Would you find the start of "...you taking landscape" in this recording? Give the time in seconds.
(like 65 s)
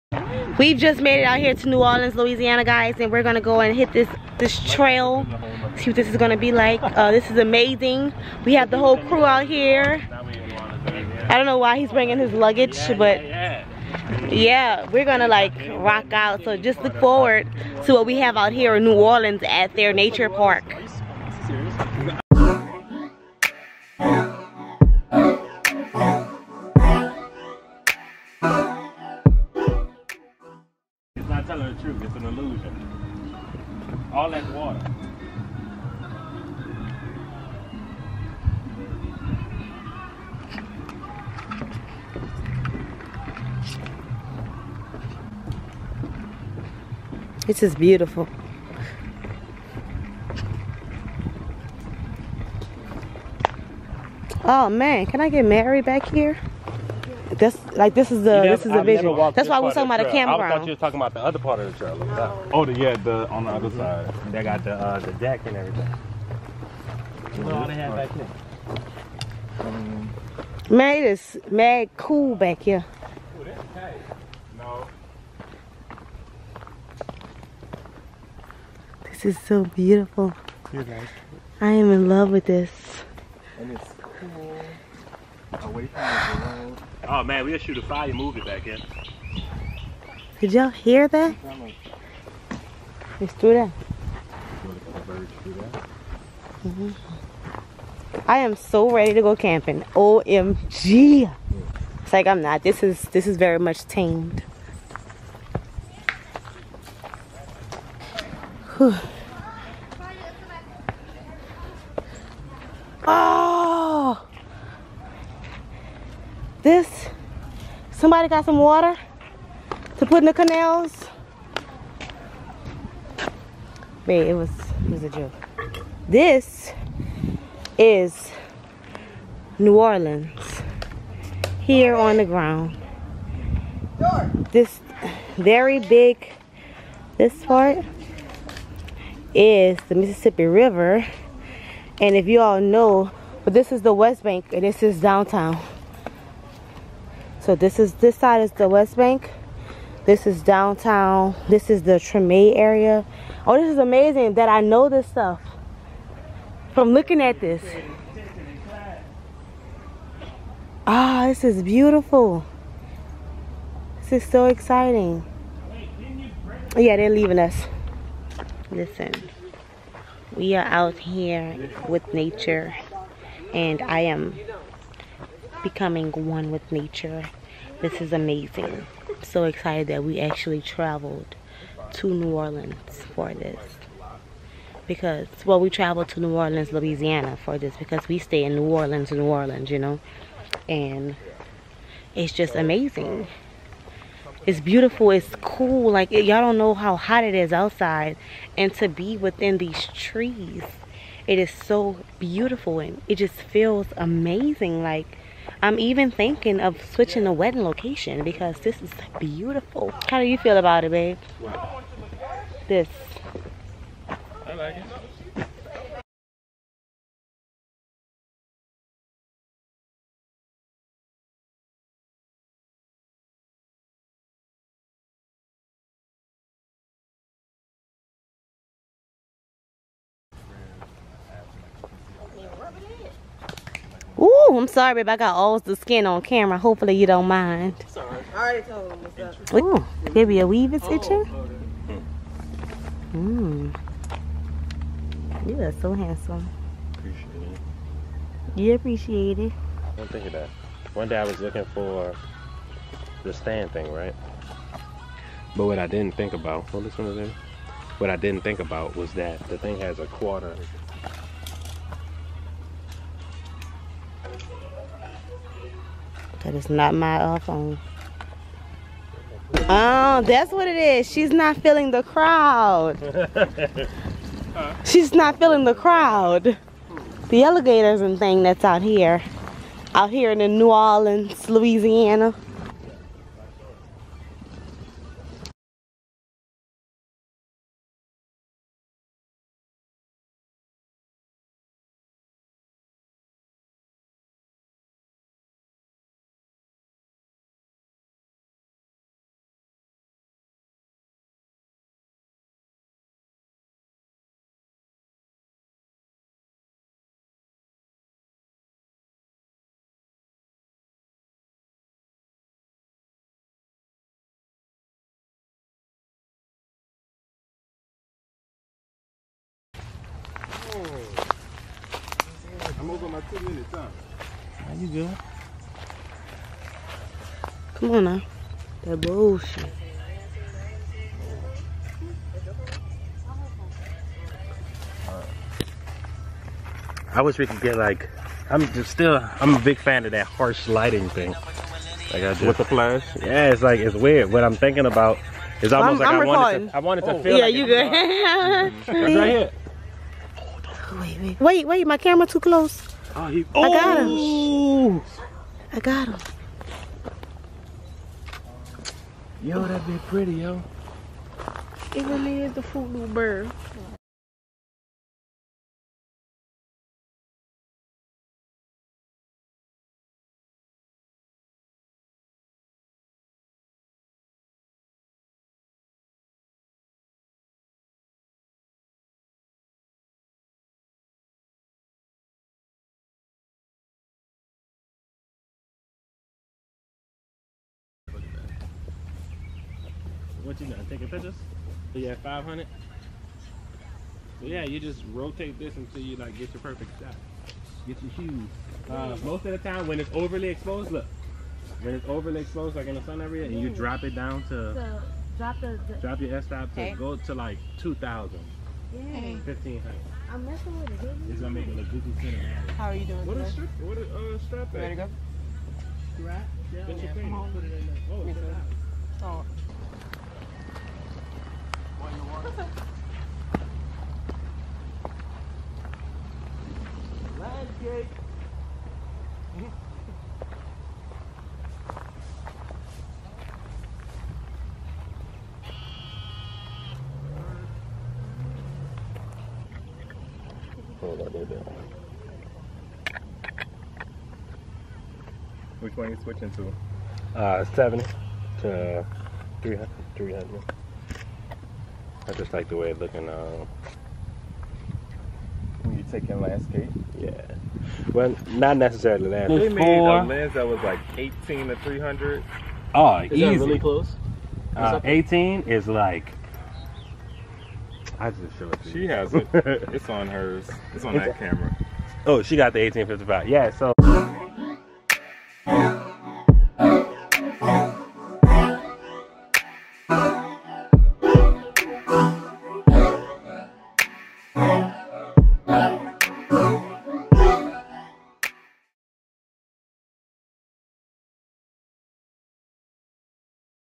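455 s.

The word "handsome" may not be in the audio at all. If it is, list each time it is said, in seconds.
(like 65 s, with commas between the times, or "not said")
245 s.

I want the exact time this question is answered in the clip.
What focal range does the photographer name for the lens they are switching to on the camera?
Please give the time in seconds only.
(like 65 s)
447 s.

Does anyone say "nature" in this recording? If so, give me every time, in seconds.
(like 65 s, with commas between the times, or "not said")
19 s, 172 s, 176 s.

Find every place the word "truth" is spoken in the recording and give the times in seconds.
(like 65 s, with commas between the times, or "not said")
31 s.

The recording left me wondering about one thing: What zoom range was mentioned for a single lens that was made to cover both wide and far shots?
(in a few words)
18 to 300.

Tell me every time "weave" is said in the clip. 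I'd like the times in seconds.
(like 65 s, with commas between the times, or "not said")
240 s.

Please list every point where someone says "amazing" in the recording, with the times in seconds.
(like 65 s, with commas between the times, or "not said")
7 s, 153 s, 178 s, 192 s, 203 s.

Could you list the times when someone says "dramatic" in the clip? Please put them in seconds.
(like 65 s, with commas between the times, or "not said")
not said.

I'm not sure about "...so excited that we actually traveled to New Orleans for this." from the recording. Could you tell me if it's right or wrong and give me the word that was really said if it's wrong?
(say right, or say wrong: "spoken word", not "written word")
right.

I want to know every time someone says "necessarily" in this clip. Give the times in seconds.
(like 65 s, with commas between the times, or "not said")
458 s.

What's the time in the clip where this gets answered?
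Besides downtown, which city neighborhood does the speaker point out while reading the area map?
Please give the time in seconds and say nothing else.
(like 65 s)
151 s.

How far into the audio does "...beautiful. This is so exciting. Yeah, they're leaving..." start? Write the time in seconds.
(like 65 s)
161 s.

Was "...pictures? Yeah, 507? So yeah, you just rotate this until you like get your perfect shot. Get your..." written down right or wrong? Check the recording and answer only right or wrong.
wrong.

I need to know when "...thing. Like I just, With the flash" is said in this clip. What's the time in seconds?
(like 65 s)
341 s.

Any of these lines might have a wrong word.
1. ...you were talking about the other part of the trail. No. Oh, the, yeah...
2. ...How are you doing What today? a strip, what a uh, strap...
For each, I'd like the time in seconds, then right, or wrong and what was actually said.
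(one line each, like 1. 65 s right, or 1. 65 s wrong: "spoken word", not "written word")
1. 60 s right
2. 412 s right.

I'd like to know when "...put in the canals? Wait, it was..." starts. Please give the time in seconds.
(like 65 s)
120 s.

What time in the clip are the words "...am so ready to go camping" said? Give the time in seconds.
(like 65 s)
98 s.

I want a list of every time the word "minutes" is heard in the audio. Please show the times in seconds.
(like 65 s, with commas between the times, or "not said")
322 s.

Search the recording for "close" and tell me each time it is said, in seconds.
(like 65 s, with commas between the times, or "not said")
352 s, 463 s.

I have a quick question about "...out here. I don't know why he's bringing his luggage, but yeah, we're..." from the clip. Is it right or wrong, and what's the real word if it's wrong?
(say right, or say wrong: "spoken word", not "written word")
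right.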